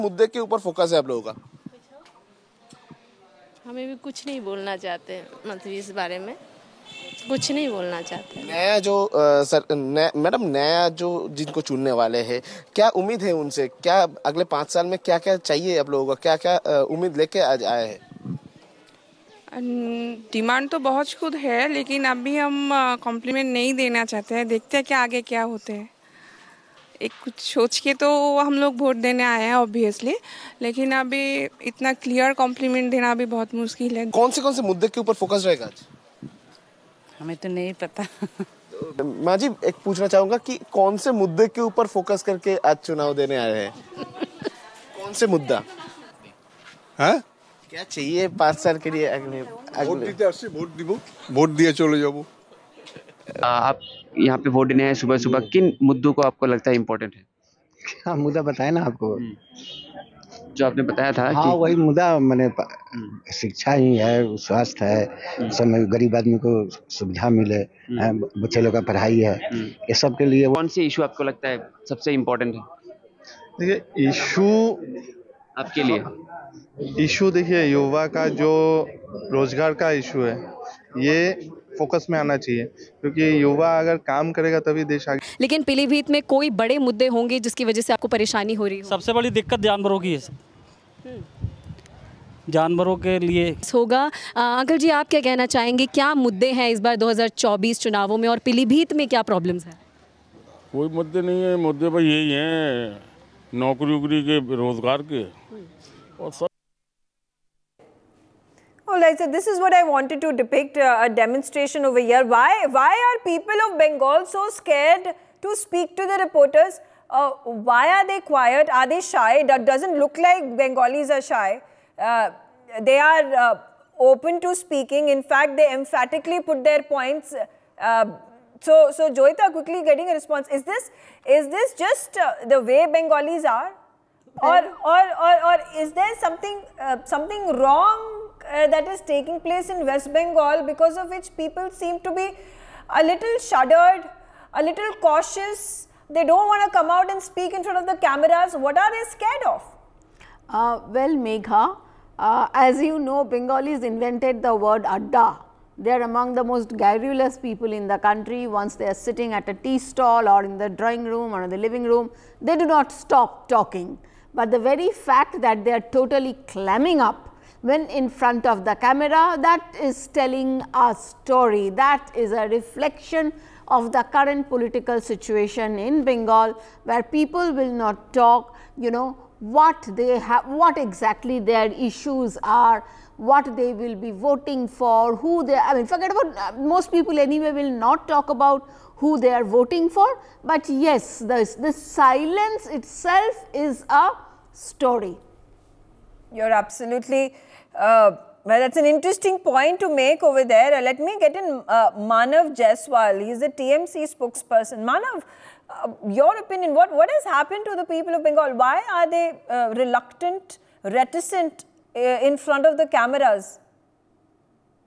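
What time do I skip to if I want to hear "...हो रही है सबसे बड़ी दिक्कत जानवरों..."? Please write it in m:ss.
1:28.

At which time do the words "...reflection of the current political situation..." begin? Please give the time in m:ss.
2:52.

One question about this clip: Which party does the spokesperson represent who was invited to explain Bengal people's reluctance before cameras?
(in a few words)
TMC.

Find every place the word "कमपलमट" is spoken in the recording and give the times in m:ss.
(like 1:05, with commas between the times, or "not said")
0:23, 0:32.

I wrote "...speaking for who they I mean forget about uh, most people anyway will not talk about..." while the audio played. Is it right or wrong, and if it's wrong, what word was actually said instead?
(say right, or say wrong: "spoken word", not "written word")
wrong: "voting", not "speaking".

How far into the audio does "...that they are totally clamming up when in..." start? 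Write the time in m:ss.
2:45.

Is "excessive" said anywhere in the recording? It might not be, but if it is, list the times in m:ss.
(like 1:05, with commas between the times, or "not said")
not said.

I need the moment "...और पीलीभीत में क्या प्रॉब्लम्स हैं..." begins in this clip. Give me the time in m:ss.
1:38.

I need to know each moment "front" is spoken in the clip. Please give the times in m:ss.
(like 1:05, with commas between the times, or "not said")
2:27, 2:48, 3:32.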